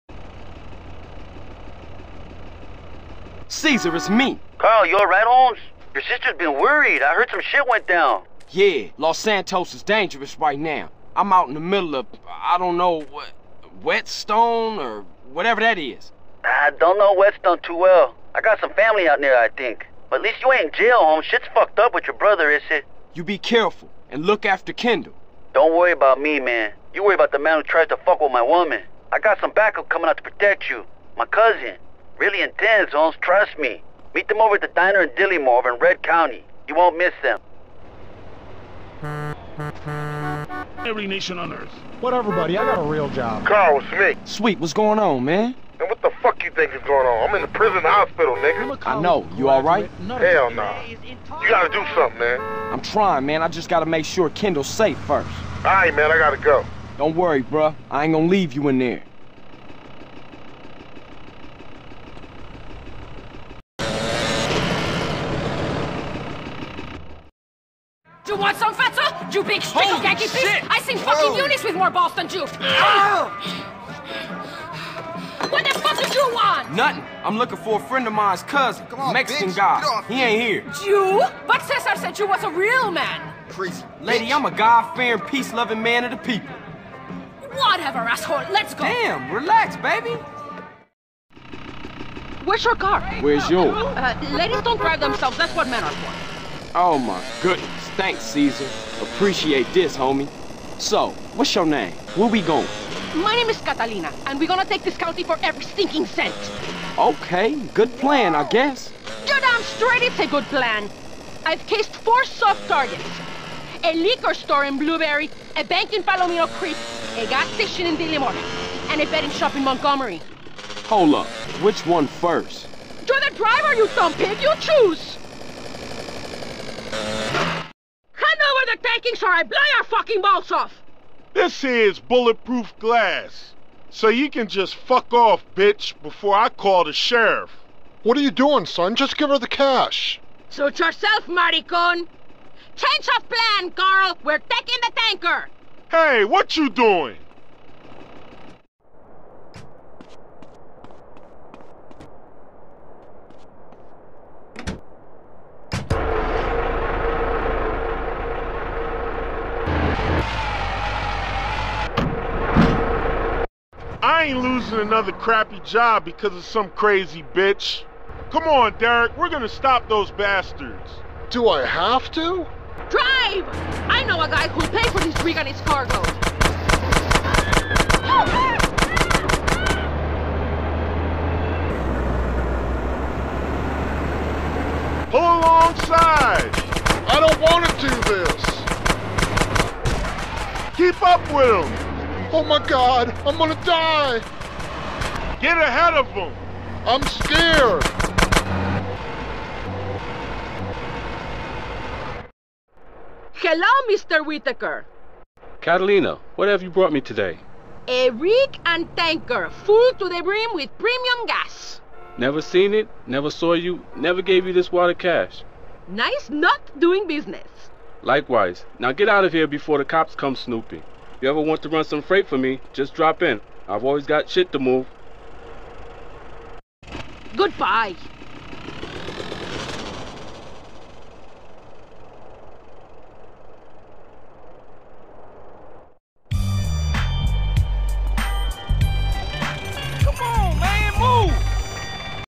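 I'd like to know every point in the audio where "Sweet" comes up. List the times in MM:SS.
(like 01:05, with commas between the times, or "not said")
00:44.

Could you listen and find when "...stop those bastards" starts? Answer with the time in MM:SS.
02:49.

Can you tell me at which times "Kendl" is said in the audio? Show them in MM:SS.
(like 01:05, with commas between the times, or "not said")
00:24, 00:54.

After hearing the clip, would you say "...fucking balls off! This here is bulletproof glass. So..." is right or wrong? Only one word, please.
right.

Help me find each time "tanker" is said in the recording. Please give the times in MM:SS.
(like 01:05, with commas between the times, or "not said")
02:24, 03:28.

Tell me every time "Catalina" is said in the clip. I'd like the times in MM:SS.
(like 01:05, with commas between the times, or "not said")
01:43, 03:25.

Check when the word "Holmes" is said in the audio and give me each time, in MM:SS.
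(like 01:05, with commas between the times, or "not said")
00:05, 00:20, 00:32.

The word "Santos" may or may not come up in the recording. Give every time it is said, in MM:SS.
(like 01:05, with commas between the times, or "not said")
00:09.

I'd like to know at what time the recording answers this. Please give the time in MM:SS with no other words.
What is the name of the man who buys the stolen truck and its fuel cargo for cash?
03:23.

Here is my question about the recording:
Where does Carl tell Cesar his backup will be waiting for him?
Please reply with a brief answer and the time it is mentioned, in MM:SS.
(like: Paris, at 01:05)
The diner in Dillimore, at 00:34.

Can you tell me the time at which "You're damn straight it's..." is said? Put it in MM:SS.
01:49.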